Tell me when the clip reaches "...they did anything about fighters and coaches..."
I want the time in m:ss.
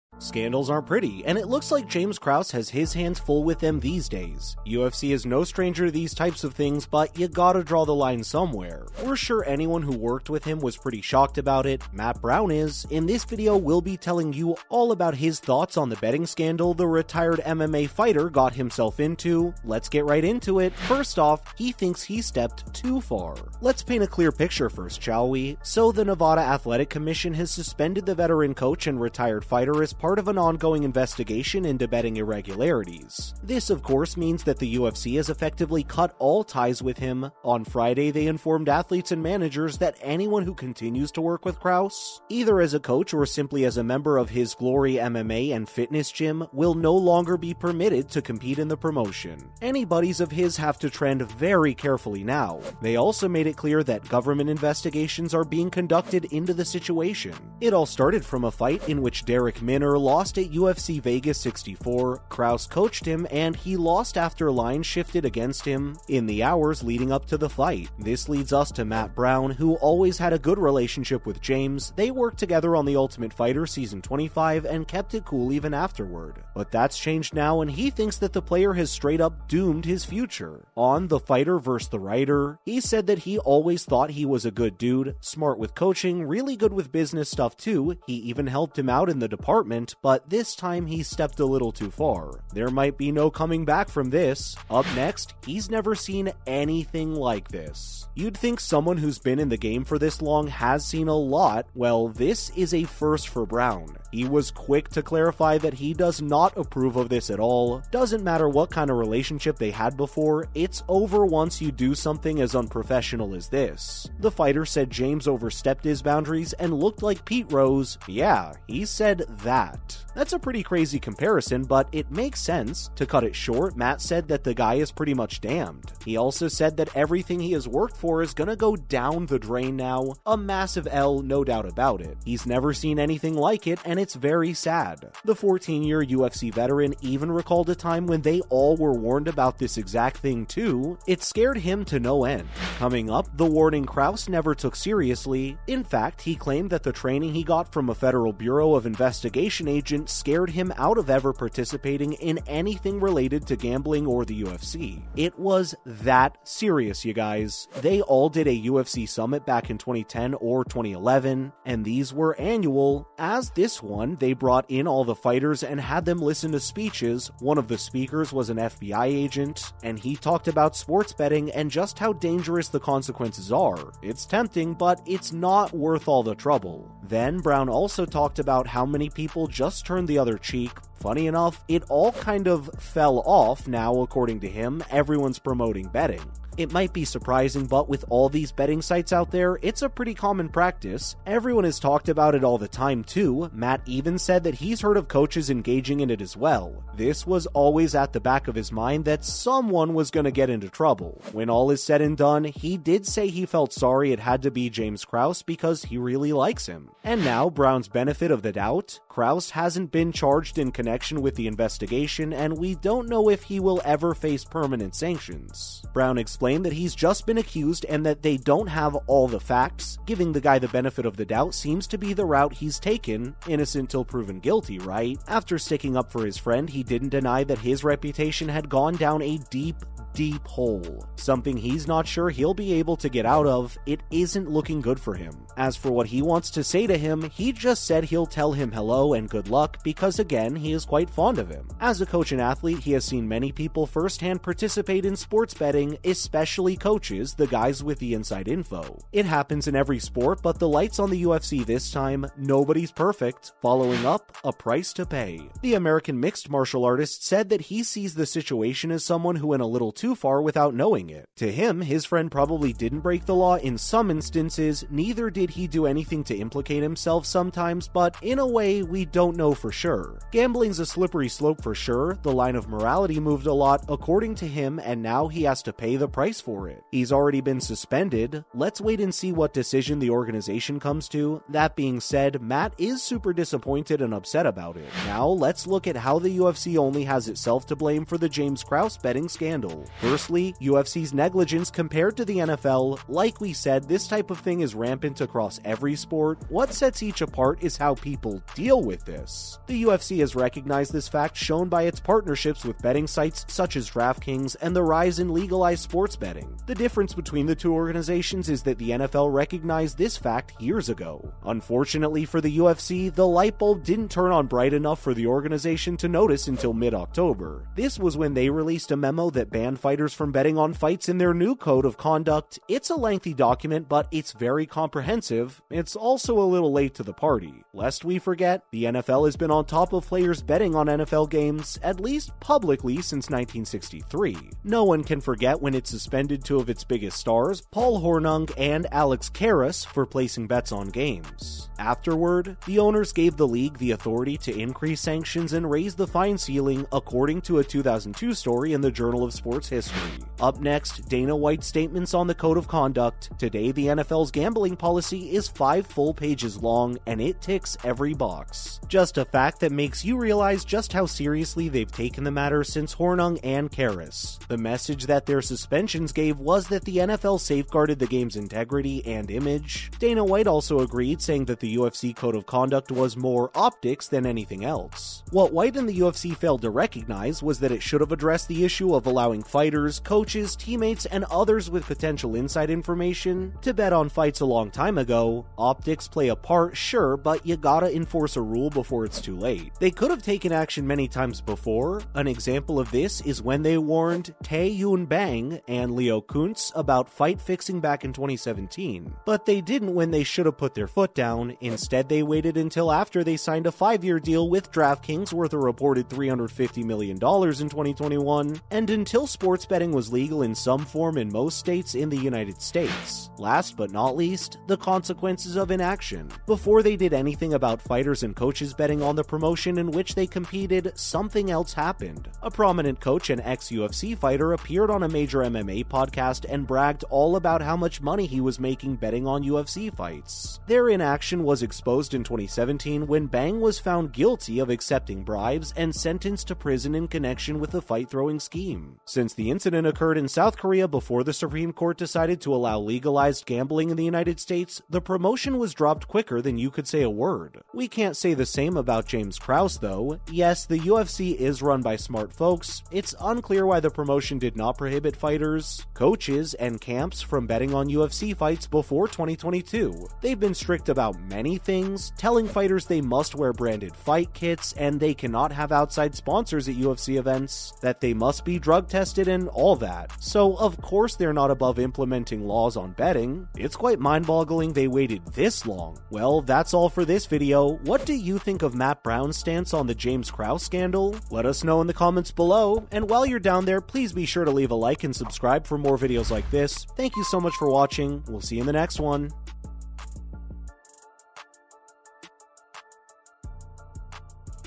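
6:56.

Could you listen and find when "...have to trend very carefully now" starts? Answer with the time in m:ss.
0:50.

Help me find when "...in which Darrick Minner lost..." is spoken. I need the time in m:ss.
0:58.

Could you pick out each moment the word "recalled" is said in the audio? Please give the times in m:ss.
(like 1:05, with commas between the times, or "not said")
2:17.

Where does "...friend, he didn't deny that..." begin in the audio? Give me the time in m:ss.
3:46.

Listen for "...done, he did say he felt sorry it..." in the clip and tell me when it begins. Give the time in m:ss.
3:22.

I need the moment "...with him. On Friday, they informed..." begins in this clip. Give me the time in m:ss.
0:36.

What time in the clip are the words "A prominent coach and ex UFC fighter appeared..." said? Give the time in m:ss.
7:02.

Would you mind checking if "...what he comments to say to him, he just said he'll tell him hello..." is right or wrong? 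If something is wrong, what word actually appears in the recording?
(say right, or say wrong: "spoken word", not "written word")
wrong: "wants", not "comments".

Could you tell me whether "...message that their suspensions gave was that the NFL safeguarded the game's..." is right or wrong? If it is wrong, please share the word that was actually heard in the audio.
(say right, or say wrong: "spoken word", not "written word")
right.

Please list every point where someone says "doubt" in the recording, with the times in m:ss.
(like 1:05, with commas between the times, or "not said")
2:11, 3:28, 3:41.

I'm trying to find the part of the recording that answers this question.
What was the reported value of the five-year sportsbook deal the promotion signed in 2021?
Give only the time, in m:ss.
6:46.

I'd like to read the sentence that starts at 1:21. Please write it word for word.
The Writer, he said that he always thought he was a good dude, smart with coaching, really good with business stuff too.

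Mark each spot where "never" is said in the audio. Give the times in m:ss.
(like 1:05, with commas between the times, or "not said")
1:35, 2:12, 2:24.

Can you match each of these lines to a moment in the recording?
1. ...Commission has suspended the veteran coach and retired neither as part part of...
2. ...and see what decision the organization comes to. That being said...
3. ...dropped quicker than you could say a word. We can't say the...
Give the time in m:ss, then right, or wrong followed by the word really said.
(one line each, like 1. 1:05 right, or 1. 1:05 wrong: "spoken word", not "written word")
1. 0:26 wrong: "fighter", not "neither"
2. 4:39 right
3. 7:25 right.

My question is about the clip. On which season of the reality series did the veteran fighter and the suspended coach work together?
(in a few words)
25.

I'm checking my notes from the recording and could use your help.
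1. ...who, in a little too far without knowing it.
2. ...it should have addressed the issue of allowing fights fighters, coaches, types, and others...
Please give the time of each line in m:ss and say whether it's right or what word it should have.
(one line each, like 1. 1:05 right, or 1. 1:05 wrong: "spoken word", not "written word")
1. 4:19 right
2. 6:17 wrong: "teammates", not "types".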